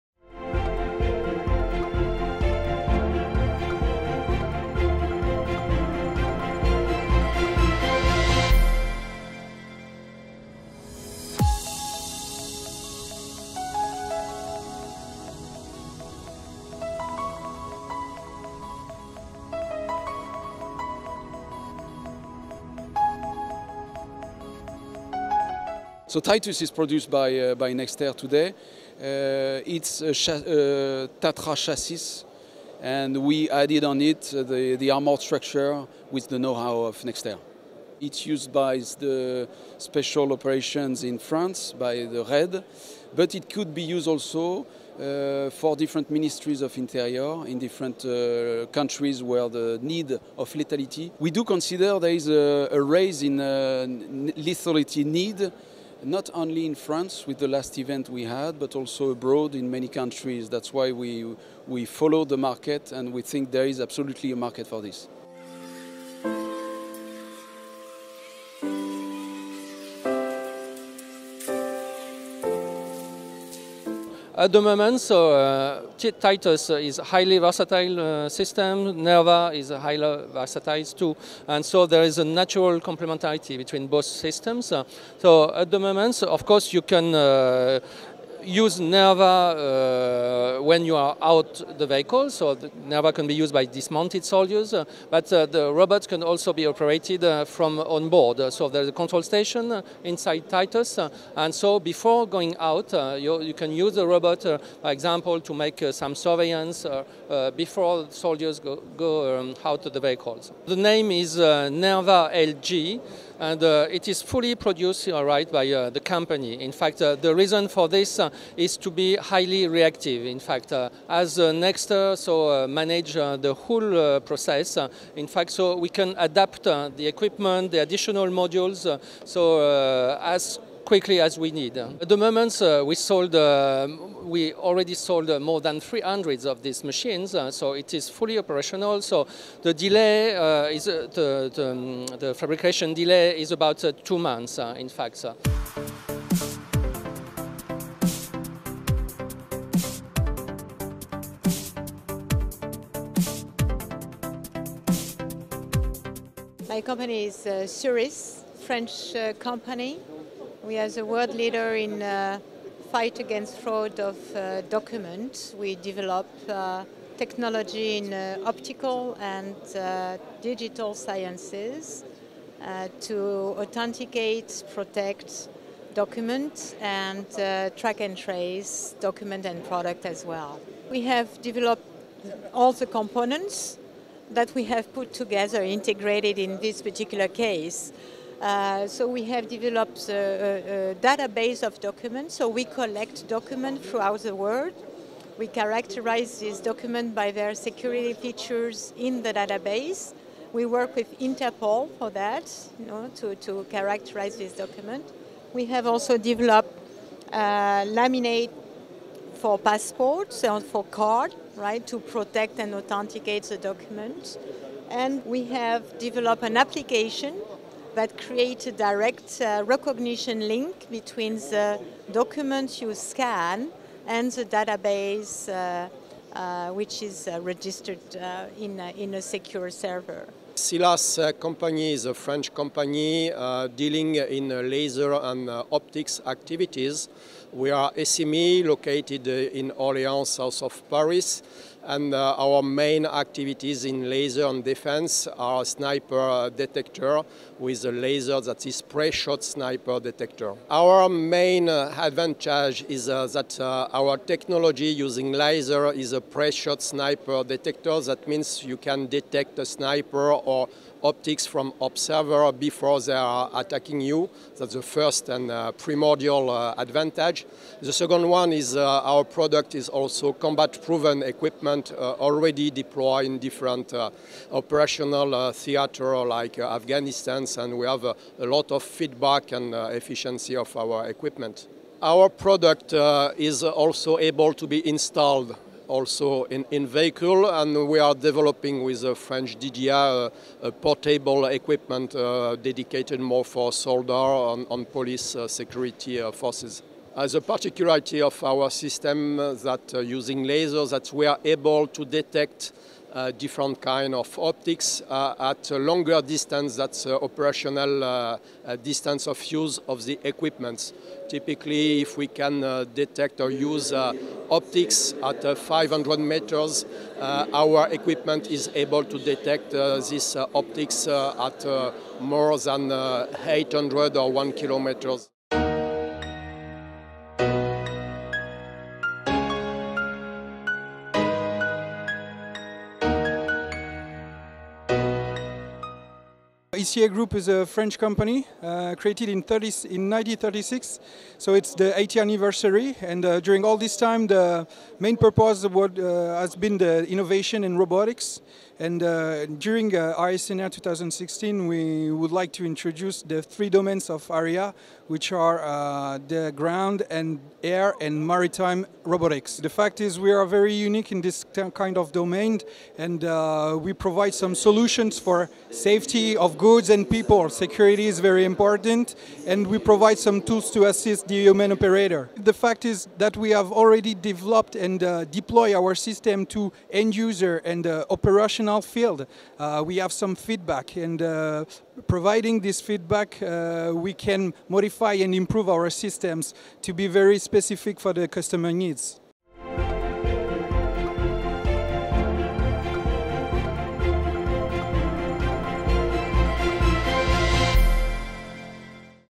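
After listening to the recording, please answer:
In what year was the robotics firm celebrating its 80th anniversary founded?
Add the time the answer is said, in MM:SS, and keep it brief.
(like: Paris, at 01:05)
1936, at 05:40.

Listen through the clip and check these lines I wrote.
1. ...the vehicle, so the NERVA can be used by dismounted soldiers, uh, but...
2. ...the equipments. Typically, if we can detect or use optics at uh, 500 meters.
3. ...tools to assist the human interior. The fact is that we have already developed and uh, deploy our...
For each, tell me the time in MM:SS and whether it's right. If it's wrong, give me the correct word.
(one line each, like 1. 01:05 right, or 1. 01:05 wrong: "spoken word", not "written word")
1. 01:31 right
2. 05:10 right
3. 06:10 wrong: "operator", not "interior".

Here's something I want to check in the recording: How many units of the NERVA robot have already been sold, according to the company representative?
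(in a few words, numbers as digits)
more than 300.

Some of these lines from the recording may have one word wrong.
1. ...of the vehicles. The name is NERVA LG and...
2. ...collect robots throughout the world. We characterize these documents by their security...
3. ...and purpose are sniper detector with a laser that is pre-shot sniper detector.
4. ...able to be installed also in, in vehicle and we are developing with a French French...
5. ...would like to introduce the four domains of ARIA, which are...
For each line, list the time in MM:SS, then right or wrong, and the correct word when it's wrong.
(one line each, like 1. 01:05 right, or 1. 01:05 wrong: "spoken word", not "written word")
1. 01:49 right
2. 03:12 wrong: "documents", not "robots"
3. 04:04 wrong: "defense", not "purpose"
4. 04:44 wrong: "DDR", not "French"
5. 05:52 wrong: "three", not "four".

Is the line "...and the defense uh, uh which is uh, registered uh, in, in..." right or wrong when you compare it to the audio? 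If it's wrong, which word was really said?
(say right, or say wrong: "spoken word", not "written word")
wrong: "database", not "defense".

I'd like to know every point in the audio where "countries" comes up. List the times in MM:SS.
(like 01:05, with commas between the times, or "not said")
00:48, 00:59.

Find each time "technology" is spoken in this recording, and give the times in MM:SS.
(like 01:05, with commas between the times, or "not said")
02:47, 04:14.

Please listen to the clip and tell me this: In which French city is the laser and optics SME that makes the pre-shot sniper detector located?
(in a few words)
Orléans.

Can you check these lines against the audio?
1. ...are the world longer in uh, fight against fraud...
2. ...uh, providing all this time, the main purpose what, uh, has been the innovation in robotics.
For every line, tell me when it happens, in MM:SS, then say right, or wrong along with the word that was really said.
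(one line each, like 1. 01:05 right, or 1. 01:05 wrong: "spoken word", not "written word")
1. 02:40 wrong: "leader", not "longer"
2. 05:43 wrong: "during", not "providing".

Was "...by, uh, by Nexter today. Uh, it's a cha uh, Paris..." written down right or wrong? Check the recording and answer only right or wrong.
wrong.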